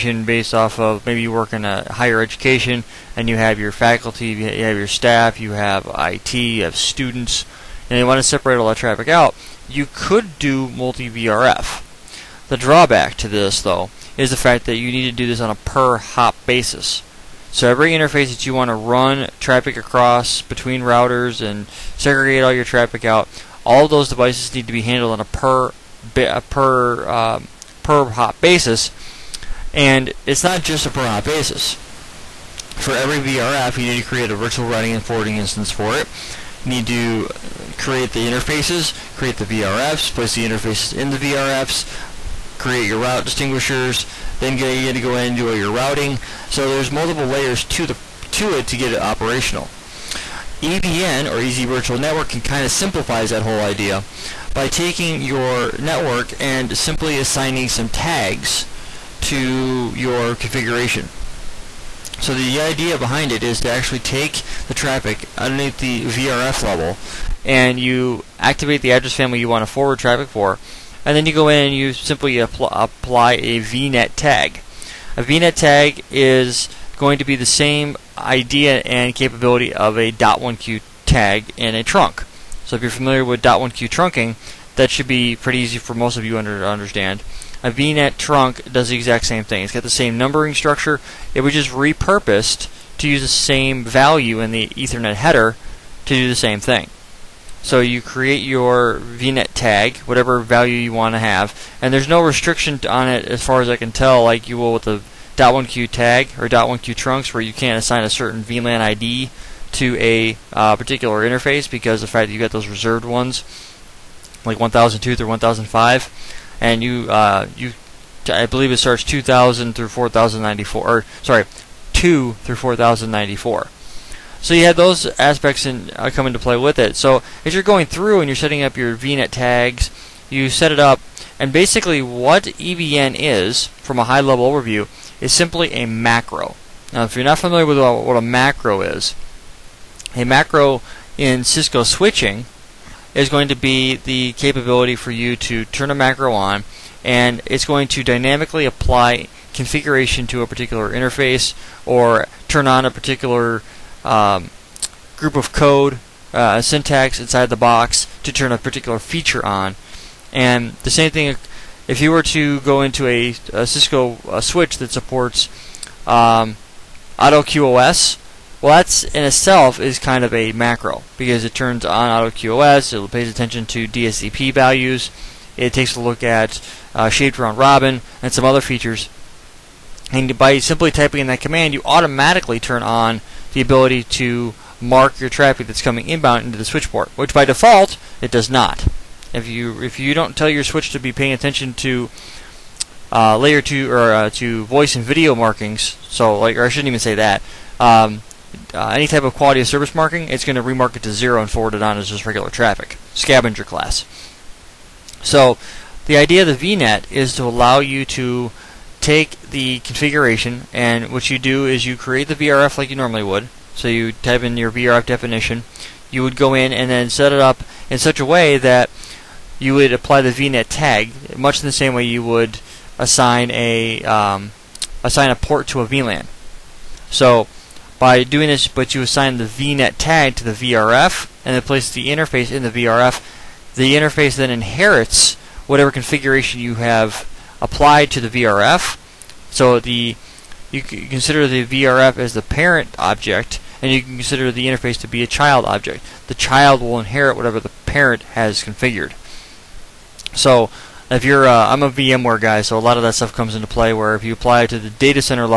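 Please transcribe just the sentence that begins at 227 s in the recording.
So by doing this, but you assign the VNet tag to the VRF and then place the interface in the VRF.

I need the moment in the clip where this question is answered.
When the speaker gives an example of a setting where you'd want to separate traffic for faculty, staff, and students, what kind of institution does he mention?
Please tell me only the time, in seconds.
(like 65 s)
1 s.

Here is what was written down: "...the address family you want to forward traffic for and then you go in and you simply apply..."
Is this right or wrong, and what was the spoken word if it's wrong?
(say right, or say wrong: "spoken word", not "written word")
right.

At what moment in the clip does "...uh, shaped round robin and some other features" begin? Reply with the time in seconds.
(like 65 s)
176 s.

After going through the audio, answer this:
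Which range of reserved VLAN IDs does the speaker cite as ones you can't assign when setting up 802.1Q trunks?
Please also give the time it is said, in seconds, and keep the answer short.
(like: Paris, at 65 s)
1002 through 1005, at 114 s.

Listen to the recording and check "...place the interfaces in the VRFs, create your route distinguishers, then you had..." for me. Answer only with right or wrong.
right.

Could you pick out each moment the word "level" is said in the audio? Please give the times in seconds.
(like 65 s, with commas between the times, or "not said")
66 s, 134 s.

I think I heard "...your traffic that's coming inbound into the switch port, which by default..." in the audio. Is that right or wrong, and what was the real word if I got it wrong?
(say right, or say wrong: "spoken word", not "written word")
right.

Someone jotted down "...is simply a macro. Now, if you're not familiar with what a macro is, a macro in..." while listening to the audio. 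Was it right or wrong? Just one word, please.
right.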